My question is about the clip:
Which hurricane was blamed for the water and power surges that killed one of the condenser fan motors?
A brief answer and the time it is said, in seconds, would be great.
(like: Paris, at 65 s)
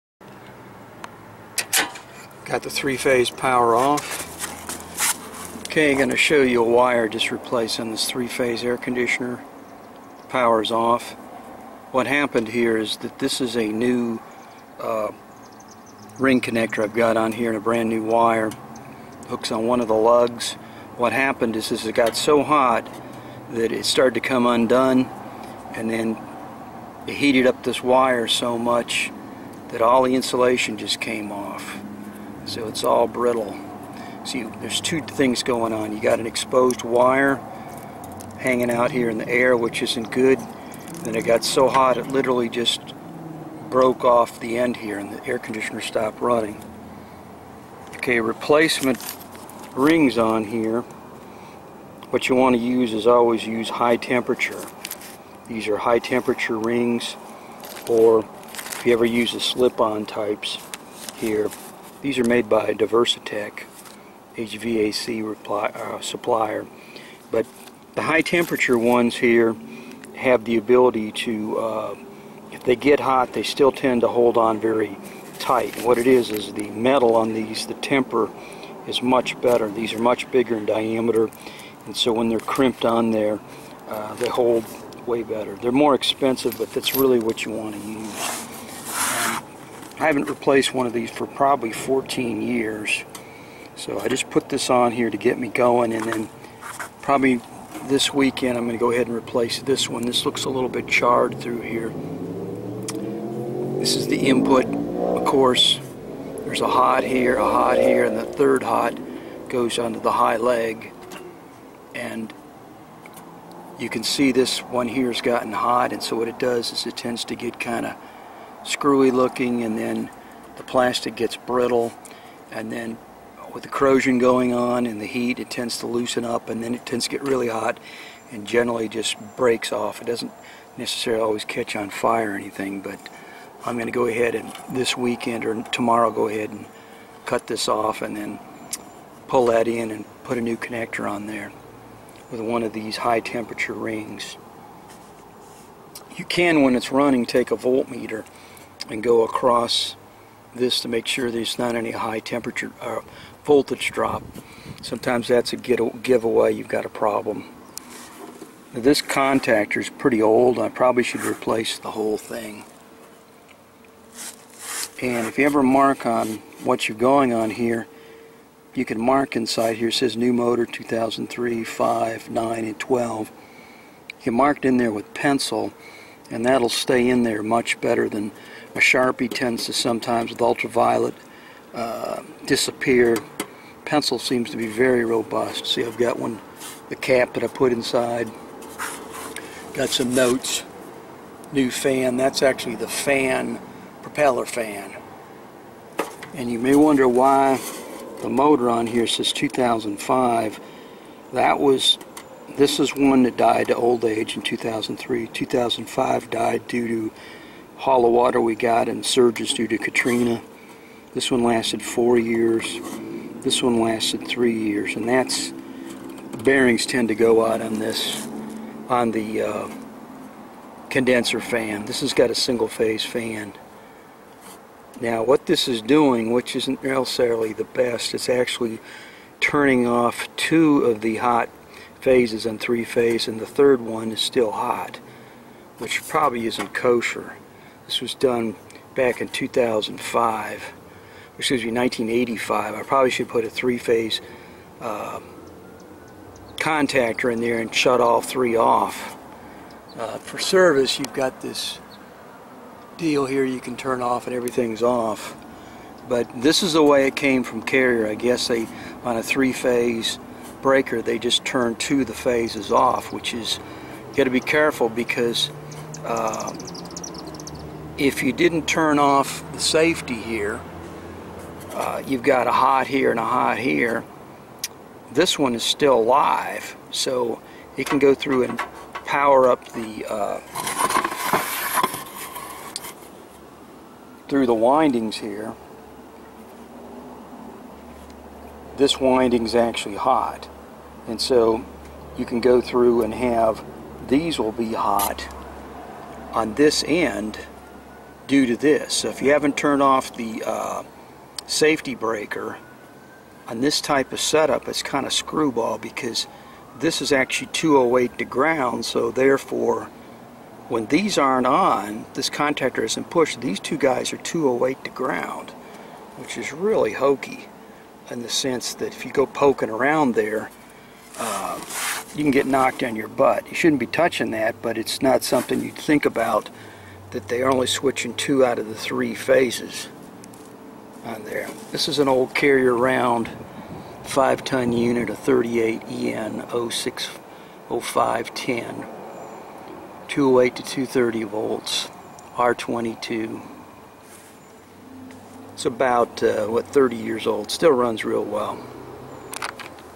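Katrina, at 209 s.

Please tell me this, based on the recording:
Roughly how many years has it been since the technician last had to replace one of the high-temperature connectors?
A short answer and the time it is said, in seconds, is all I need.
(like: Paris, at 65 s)
14 years, at 91 s.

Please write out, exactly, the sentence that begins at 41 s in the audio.
Then it got so hot it literally just broke off the end here and the air conditioner stopped running.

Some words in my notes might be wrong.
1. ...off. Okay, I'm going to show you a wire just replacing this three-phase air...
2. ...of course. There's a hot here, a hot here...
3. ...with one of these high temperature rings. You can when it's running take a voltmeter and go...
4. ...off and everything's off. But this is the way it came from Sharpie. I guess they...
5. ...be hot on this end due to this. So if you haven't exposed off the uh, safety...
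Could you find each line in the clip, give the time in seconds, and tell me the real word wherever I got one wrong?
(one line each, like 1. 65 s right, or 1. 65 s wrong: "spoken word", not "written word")
1. 3 s right
2. 104 s right
3. 142 s right
4. 254 s wrong: "Carrier", not "Sharpie"
5. 294 s wrong: "turned", not "exposed".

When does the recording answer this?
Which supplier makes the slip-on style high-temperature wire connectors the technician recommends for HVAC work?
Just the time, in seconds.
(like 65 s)
62 s.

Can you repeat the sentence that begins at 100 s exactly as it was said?
This looks a little bit charred through here.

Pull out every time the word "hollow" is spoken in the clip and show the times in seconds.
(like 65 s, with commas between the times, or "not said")
207 s.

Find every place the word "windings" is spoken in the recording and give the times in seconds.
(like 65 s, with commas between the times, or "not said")
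284 s, 288 s.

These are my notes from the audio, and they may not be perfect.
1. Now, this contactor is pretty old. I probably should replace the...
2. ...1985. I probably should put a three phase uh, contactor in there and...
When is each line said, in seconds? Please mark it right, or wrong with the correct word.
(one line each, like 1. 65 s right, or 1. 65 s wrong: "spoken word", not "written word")
1. 158 s right
2. 241 s right.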